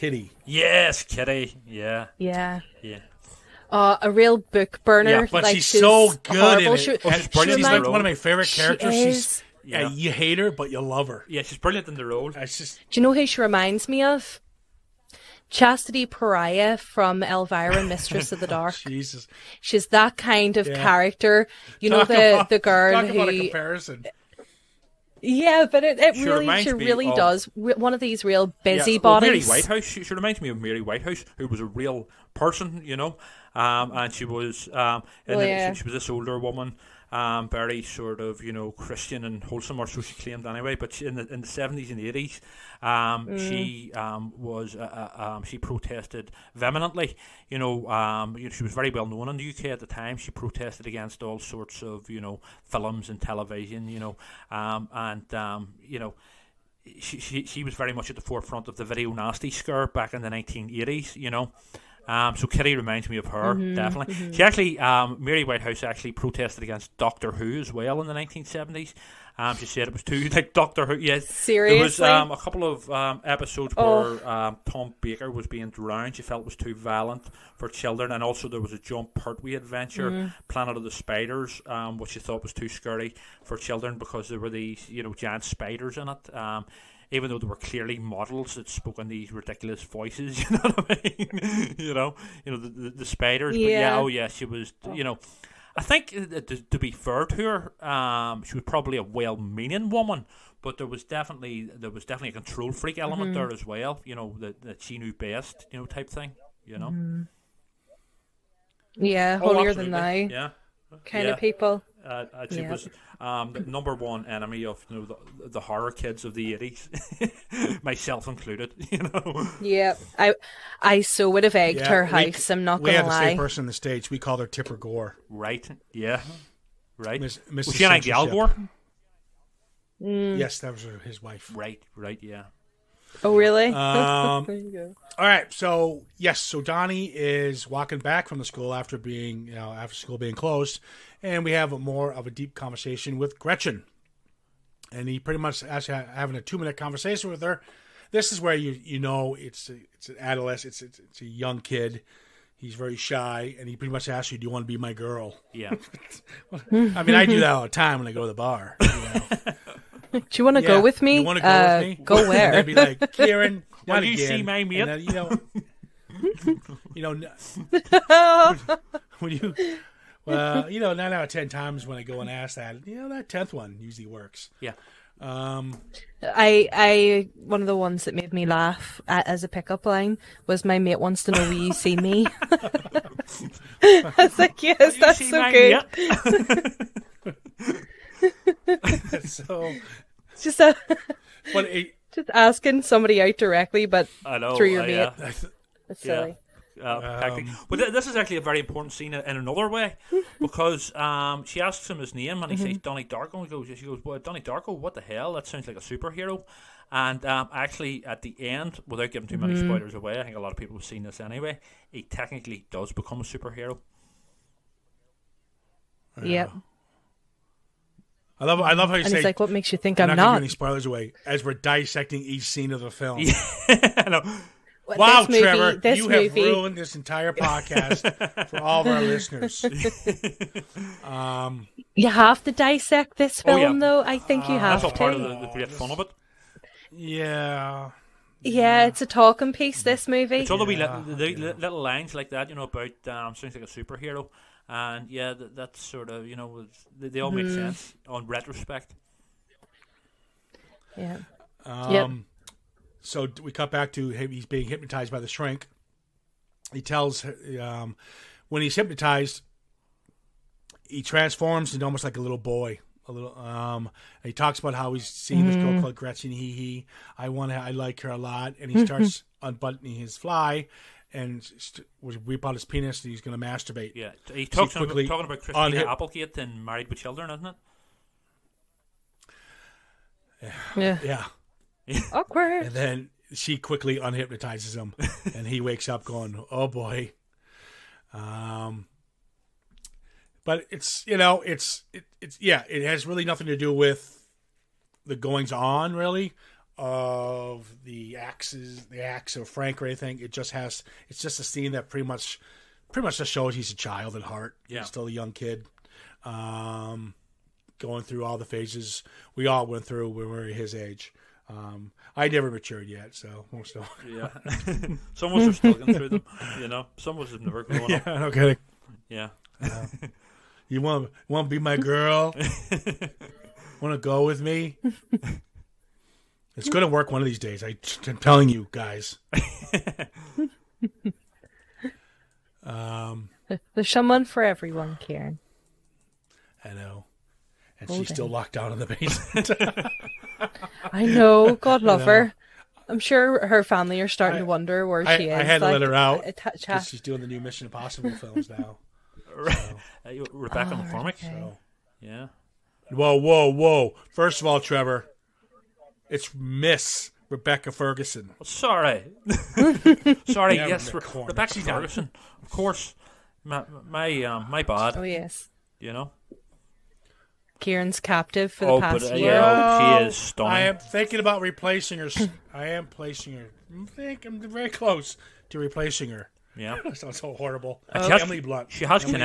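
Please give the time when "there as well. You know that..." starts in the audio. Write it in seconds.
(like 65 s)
103 s.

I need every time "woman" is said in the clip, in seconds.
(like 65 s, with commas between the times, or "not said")
36 s, 99 s.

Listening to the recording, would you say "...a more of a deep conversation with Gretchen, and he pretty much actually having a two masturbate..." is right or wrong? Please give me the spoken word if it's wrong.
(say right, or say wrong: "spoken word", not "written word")
wrong: "minute", not "masturbate".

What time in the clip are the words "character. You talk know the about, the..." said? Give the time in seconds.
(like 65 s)
20 s.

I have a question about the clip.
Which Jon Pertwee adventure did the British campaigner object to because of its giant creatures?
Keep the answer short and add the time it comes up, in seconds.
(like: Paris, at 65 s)
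Planet of the Spiders, at 80 s.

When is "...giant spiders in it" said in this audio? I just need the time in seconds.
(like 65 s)
85 s.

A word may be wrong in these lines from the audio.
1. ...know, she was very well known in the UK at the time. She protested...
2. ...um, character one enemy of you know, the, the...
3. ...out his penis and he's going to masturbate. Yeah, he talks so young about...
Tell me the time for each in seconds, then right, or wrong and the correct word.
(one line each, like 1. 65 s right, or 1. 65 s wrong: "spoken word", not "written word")
1. 48 s right
2. 113 s wrong: "number", not "character"
3. 272 s wrong: "talking", not "young".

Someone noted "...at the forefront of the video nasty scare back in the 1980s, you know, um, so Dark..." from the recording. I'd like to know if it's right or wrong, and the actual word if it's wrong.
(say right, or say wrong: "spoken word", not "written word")
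wrong: "Kitty", not "Dark".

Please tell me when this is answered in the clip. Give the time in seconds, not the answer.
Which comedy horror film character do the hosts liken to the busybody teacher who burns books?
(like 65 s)
15 s.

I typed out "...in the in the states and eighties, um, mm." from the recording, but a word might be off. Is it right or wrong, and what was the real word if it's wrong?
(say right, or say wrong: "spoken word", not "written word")
wrong: "seventies", not "states".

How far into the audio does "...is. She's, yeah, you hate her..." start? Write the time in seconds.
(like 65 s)
8 s.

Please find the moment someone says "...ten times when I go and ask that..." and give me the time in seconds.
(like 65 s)
171 s.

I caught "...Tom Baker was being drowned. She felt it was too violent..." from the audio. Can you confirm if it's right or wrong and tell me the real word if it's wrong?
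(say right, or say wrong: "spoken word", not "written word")
right.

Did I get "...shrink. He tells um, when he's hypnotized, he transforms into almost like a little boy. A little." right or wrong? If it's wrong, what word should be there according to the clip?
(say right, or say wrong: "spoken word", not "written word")
right.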